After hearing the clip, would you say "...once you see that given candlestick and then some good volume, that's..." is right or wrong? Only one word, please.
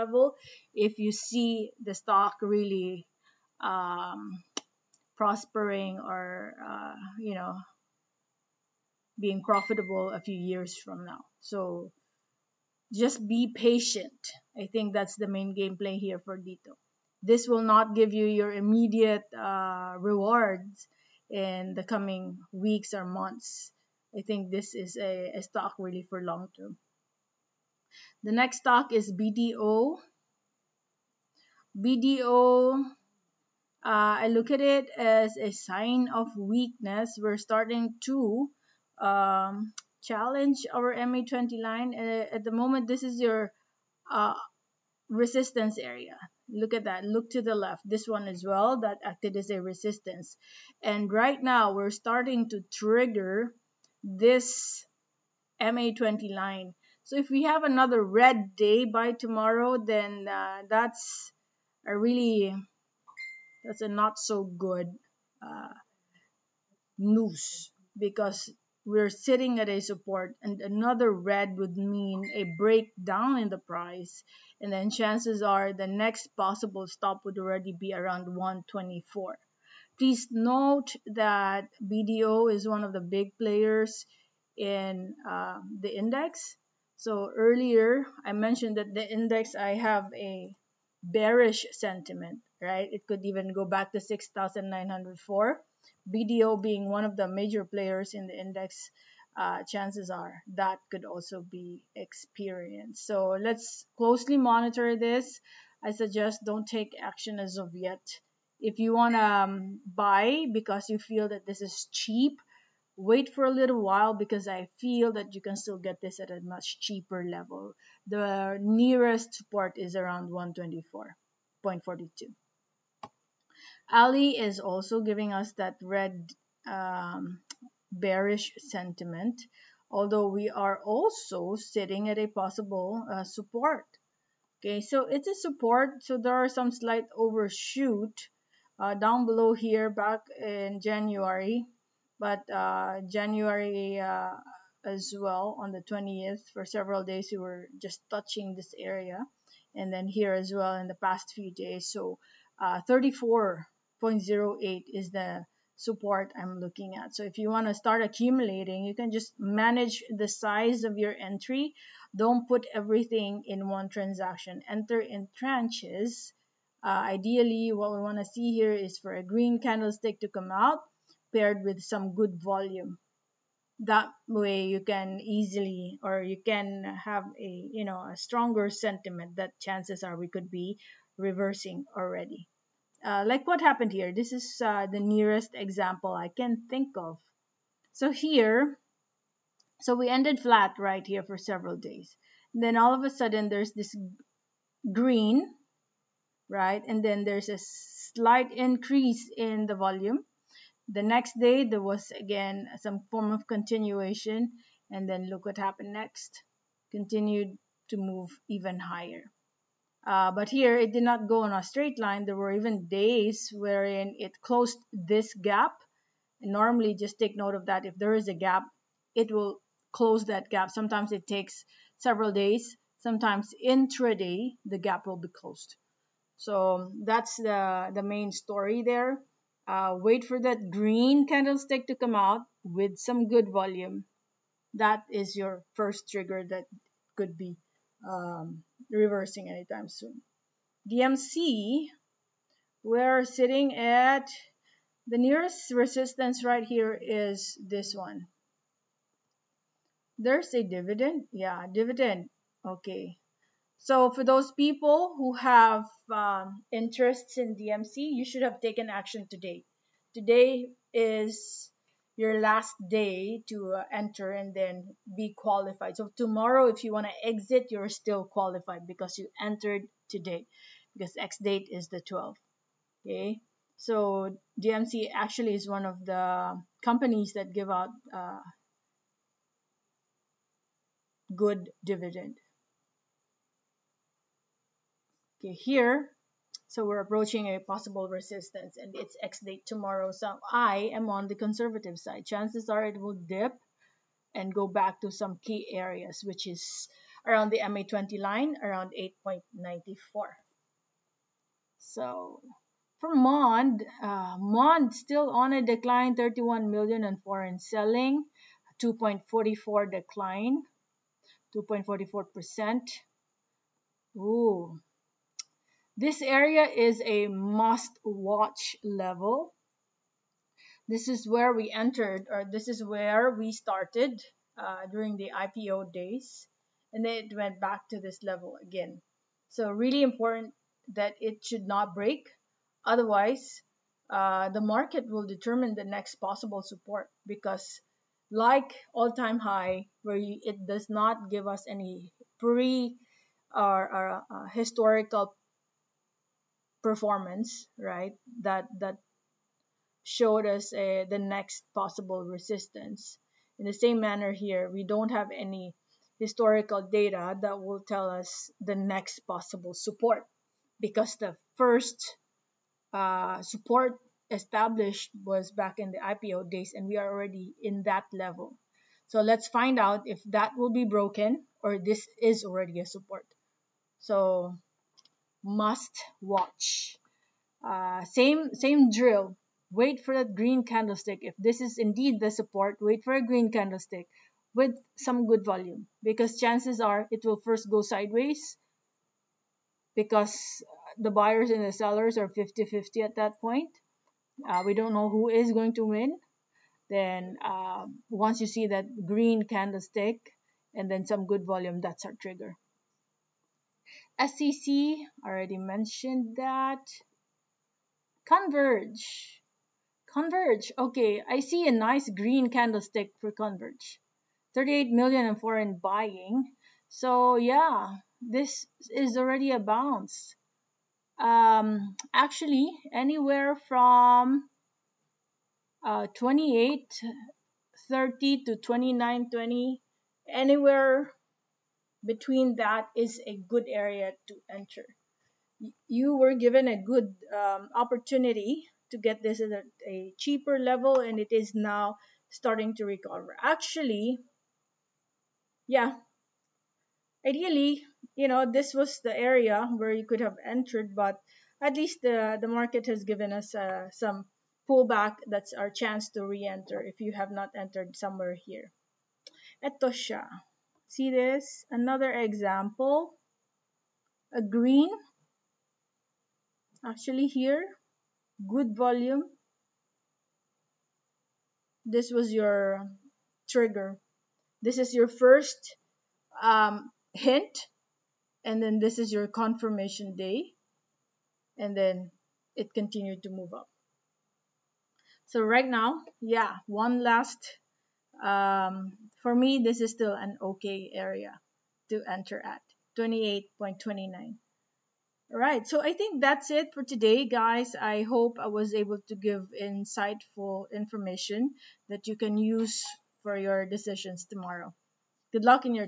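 wrong.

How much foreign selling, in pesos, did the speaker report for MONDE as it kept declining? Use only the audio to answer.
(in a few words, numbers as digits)
31 million.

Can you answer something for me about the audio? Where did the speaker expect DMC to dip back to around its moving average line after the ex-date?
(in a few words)
8.94.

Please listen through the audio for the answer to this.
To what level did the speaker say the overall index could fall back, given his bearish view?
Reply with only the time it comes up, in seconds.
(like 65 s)
93 s.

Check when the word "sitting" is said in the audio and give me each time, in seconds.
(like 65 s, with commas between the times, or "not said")
69 s, 131 s, 243 s.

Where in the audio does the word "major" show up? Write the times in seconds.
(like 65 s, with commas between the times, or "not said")
97 s.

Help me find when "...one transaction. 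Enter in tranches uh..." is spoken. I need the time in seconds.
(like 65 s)
163 s.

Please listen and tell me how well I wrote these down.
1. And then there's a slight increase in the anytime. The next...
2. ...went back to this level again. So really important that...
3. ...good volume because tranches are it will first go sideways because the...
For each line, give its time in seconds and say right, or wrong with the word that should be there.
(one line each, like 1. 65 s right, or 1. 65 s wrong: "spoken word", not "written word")
1. 196 s wrong: "volume", not "anytime"
2. 327 s right
3. 385 s wrong: "chances", not "tranches".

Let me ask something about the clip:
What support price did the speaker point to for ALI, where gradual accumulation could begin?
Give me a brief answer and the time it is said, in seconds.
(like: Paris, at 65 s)
34.08, at 152 s.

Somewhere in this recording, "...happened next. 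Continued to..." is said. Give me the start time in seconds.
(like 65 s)
205 s.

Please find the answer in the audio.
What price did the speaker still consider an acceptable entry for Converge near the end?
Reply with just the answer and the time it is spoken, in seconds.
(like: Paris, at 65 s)
28.29, at 492 s.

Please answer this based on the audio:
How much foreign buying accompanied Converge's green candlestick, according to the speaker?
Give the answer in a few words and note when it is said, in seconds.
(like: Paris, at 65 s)
38 million, at 414 s.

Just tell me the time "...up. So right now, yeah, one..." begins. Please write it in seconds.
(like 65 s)
483 s.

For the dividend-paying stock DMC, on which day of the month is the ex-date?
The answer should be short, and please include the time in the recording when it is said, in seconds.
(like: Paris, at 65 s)
12th, at 271 s.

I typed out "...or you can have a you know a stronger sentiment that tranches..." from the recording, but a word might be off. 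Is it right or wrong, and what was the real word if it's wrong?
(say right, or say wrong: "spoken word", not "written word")
wrong: "chances", not "tranches".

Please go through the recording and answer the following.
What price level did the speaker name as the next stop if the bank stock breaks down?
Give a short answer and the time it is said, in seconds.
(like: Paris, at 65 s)
124, at 78 s.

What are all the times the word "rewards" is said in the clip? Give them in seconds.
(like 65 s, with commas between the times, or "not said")
19 s.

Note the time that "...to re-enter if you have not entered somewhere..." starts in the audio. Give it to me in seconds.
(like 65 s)
456 s.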